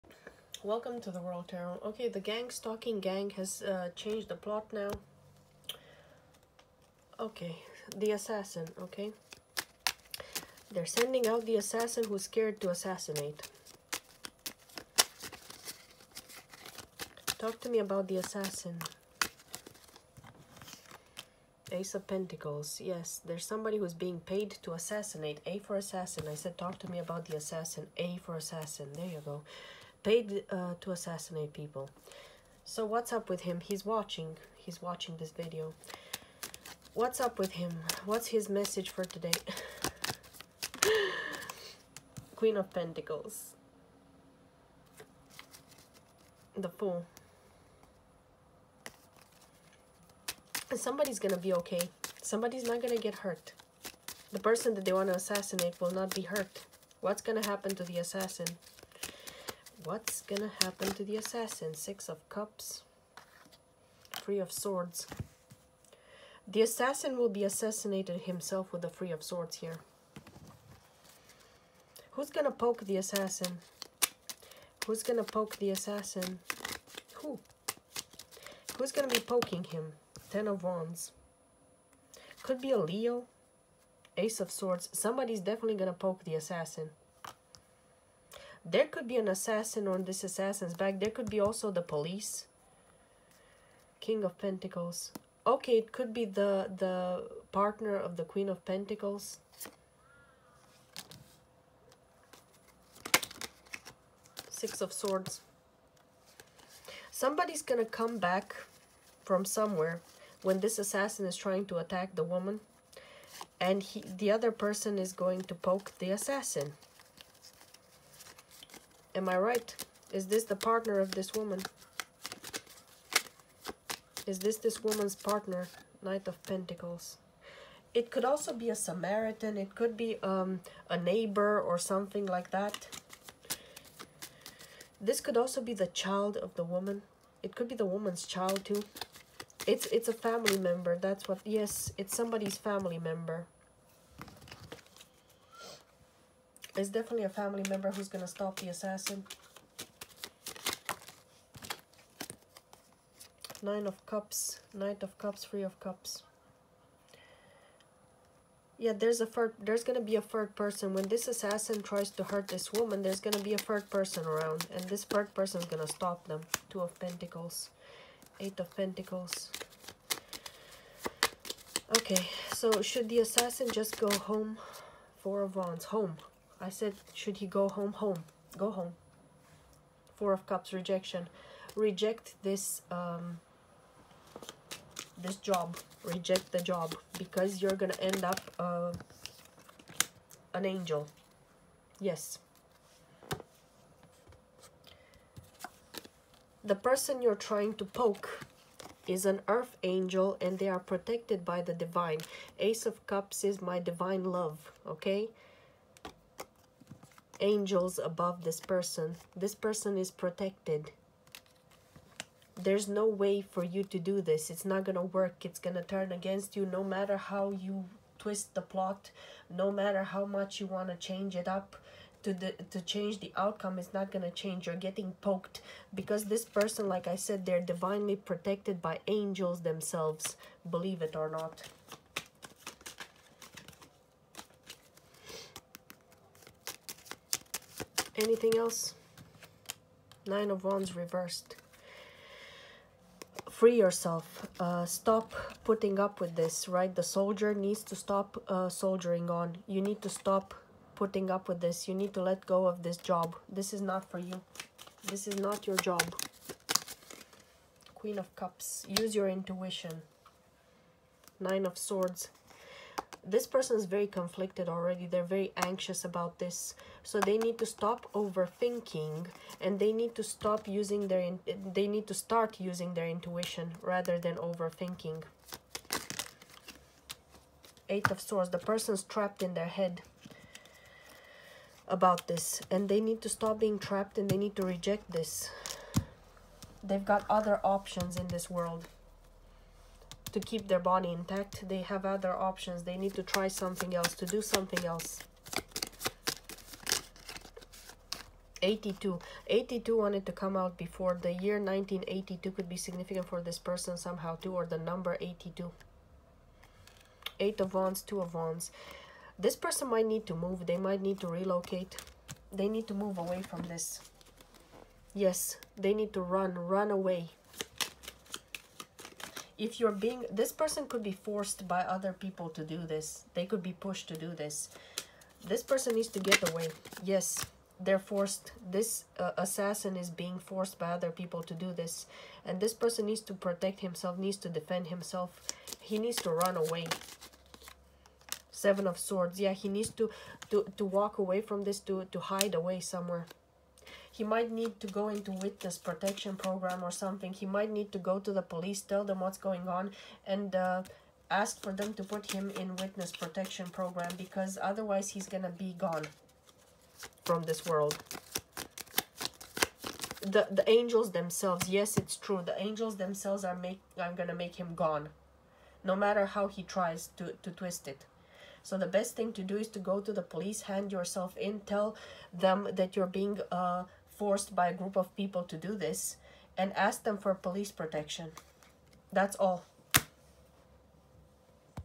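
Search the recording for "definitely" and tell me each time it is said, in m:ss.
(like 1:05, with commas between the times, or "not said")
1:25, 2:26.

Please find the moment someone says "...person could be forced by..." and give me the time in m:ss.
5:20.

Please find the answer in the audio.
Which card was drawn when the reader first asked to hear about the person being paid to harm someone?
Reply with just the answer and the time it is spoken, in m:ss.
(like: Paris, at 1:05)
Ace of Pentacles, at 0:21.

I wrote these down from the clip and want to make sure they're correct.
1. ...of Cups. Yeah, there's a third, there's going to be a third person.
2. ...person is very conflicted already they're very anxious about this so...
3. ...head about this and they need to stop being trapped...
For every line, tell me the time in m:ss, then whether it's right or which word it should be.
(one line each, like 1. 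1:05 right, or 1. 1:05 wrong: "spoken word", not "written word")
1. 2:35 right
2. 4:23 right
3. 4:39 right.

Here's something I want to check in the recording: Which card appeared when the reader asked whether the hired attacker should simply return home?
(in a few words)
Four of Wands.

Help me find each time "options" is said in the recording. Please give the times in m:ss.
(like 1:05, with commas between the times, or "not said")
4:47, 4:52.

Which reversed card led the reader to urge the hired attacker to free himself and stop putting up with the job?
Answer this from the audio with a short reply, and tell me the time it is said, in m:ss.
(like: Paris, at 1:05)
Nine of Wands reversed, at 4:00.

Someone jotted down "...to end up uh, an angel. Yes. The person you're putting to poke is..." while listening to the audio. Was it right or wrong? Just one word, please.
wrong.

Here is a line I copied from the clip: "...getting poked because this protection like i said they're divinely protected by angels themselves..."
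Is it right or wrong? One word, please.
wrong.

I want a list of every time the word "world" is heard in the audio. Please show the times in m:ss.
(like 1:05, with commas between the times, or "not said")
0:01, 4:48, 5:57.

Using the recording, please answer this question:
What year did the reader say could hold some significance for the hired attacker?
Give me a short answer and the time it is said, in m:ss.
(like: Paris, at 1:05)
1982, at 5:01.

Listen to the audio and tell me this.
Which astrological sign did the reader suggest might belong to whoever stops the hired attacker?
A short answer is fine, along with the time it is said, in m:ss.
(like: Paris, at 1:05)
Leo, at 1:22.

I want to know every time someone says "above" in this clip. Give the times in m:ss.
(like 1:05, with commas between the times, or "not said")
3:27.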